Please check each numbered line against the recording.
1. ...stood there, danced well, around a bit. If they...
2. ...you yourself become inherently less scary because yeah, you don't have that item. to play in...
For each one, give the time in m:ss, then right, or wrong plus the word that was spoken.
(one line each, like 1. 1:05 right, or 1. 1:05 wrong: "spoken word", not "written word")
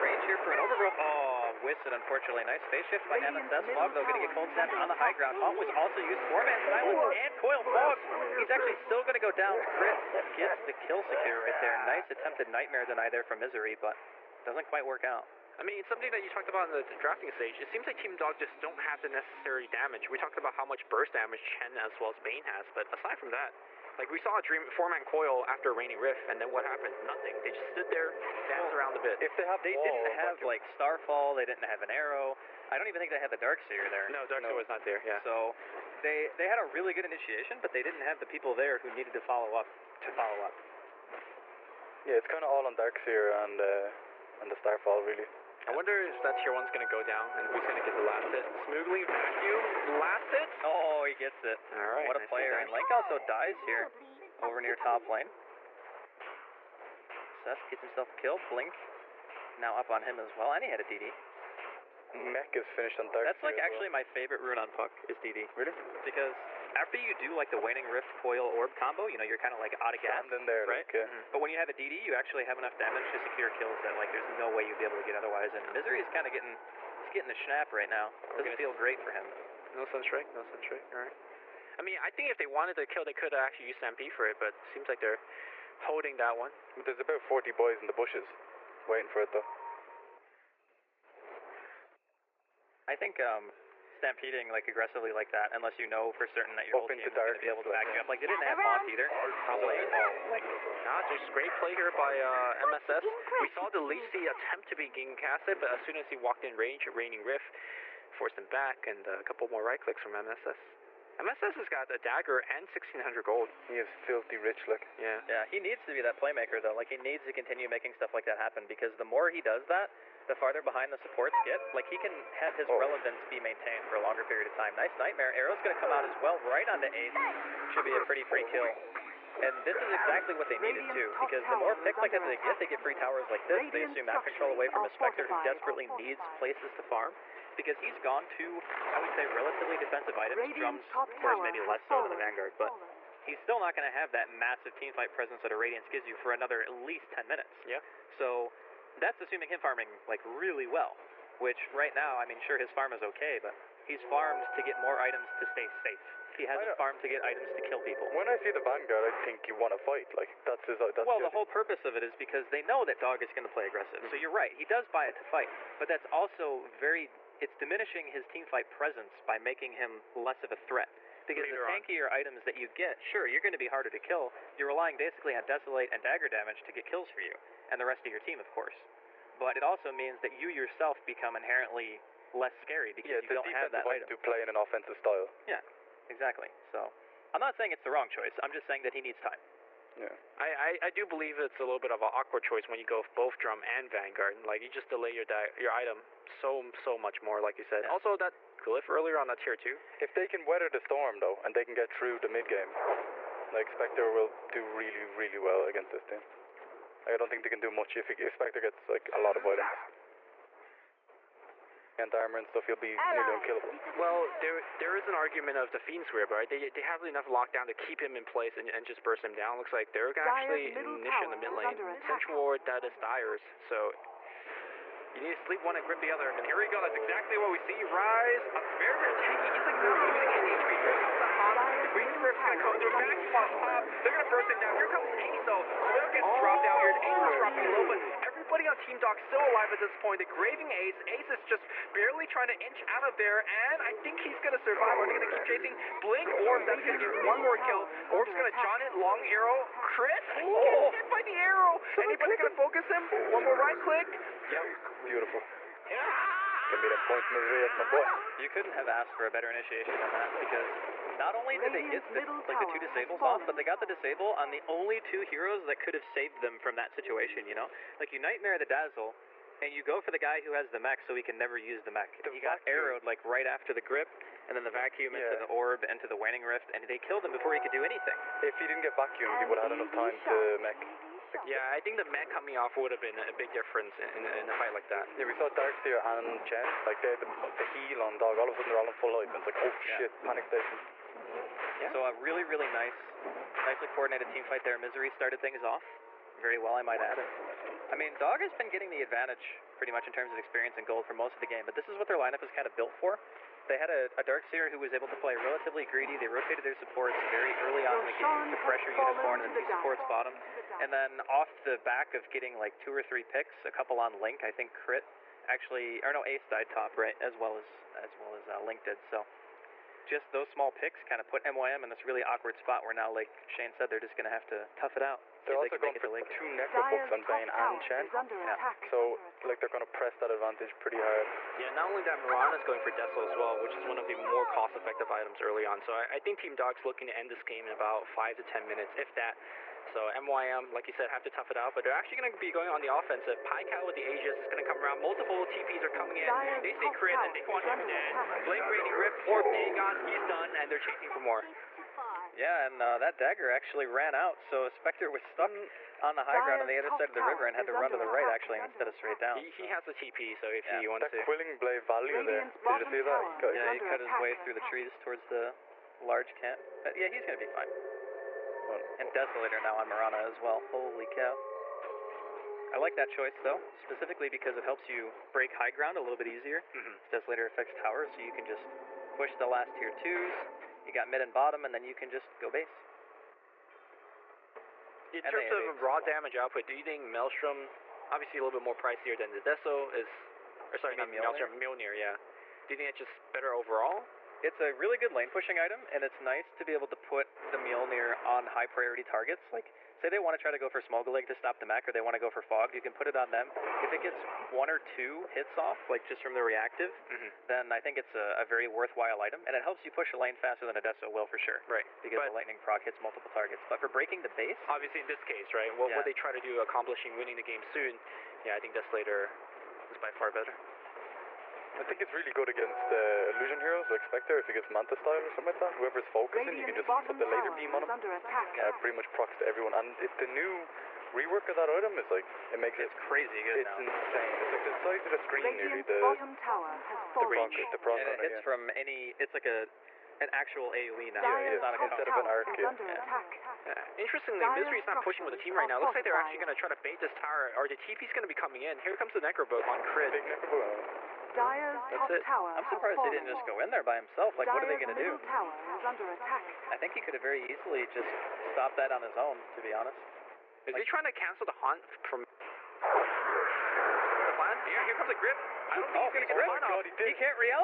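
1. 0:27 right
2. 3:00 right.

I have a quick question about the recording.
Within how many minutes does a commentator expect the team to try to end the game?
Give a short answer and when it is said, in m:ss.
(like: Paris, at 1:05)
5 to 10, at 5:38.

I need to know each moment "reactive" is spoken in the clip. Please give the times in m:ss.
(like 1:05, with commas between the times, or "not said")
6:46.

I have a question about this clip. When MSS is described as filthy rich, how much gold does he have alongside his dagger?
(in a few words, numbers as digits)
1600.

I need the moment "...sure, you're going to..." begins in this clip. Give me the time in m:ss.
2:53.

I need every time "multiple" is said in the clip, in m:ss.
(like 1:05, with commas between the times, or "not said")
5:45, 6:53.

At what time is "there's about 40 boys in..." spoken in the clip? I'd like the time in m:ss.
1:26.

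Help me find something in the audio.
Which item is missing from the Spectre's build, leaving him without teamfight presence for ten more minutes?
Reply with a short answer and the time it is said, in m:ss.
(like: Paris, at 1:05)
Radiance, at 2:25.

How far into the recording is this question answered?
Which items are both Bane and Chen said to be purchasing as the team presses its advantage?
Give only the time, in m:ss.
5:26.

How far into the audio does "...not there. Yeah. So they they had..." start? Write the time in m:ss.
0:34.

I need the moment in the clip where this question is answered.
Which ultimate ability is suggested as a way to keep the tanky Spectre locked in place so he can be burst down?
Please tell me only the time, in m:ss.
3:35.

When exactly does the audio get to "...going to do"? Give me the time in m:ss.
7:34.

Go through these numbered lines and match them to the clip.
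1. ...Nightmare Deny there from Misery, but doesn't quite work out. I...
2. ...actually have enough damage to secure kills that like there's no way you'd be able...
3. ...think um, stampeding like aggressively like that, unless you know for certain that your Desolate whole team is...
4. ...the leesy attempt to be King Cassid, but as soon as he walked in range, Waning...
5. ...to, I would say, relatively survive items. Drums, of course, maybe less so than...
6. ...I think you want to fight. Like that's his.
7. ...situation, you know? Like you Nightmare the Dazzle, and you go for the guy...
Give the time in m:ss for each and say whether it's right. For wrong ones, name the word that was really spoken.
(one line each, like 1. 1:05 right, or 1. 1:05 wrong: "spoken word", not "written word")
1. 0:12 right
2. 1:12 right
3. 1:32 wrong: "Open", not "Desolate"
4. 1:43 right
5. 2:18 wrong: "defensive", not "survive"
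6. 2:39 right
7. 4:26 right.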